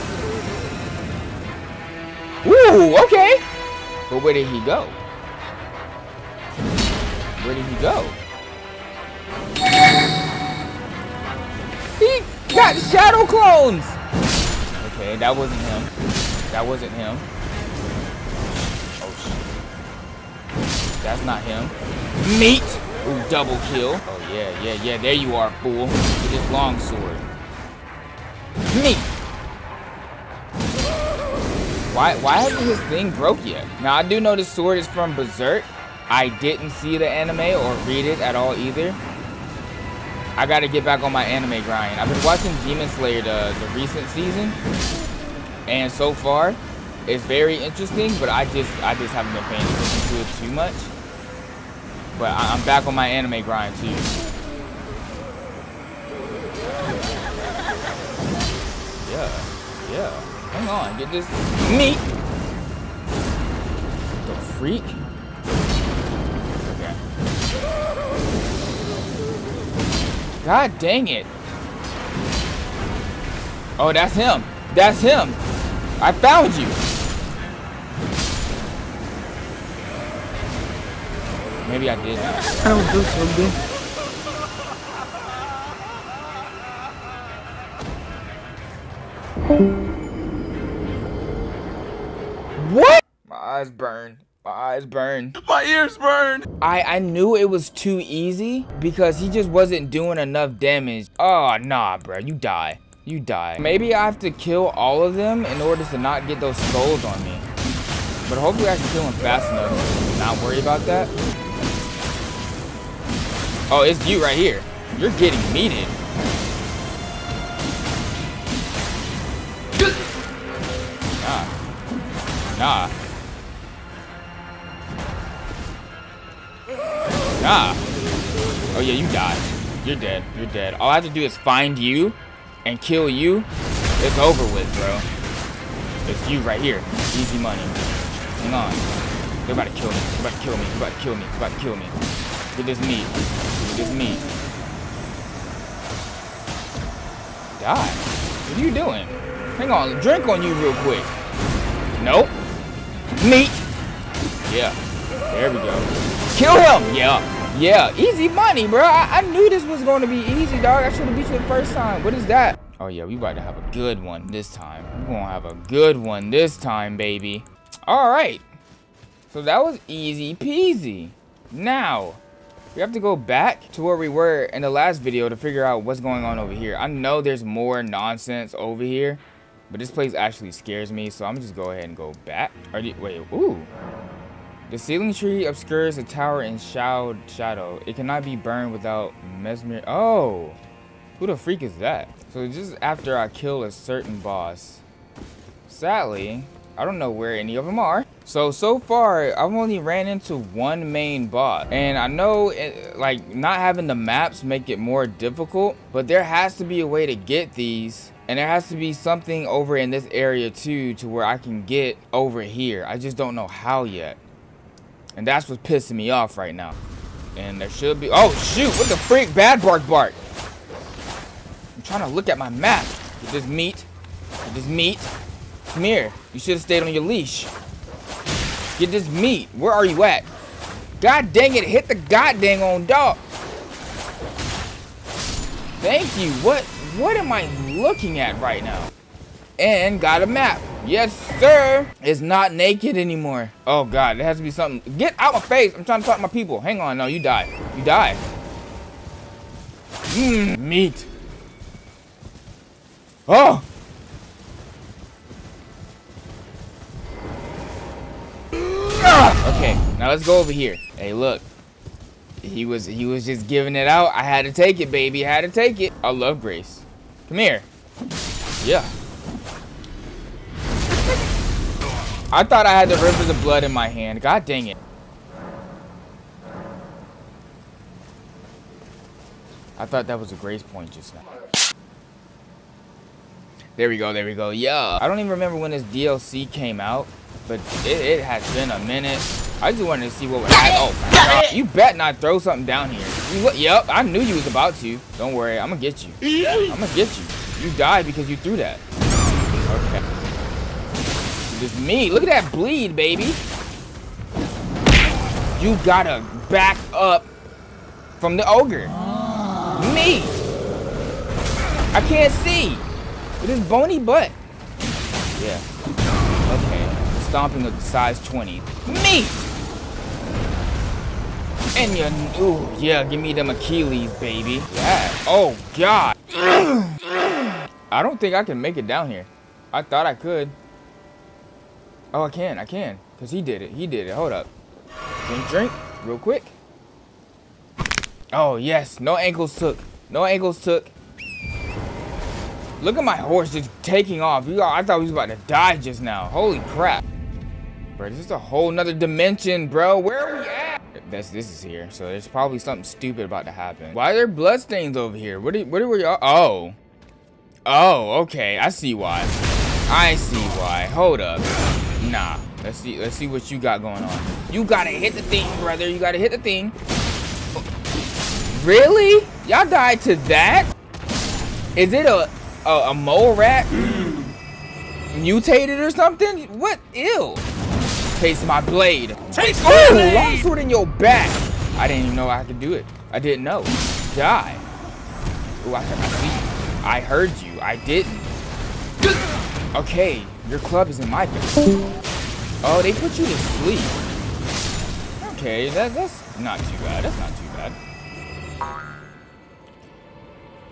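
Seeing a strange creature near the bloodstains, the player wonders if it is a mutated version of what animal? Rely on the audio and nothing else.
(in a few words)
mole rat.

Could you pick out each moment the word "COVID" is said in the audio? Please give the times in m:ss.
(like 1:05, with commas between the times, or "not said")
not said.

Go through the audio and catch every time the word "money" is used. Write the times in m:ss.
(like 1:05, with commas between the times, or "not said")
2:17, 2:38.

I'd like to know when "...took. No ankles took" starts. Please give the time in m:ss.
5:39.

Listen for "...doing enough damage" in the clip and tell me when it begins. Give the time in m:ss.
1:39.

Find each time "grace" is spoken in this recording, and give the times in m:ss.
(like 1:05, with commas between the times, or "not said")
4:26, 4:40.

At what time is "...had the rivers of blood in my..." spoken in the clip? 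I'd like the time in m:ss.
4:32.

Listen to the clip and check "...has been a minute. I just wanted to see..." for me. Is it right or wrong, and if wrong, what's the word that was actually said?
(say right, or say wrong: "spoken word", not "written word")
right.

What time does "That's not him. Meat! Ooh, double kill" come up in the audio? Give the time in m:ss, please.
0:21.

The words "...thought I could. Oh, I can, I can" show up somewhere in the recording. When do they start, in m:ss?
5:29.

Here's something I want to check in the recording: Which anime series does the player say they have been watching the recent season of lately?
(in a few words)
Demon Slayer.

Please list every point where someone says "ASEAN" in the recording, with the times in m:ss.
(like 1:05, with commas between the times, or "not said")
not said.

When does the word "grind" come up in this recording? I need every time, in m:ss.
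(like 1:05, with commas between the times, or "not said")
0:41, 0:53.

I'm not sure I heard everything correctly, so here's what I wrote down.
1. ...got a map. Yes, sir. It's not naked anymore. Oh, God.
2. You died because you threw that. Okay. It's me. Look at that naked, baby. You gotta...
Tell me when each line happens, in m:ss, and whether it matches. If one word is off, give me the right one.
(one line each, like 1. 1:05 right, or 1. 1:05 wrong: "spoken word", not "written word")
1. 3:59 right
2. 4:57 wrong: "bleed", not "naked".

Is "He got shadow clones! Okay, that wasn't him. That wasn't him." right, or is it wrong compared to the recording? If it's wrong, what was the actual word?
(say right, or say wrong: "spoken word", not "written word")
right.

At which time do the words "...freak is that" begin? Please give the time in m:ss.
3:11.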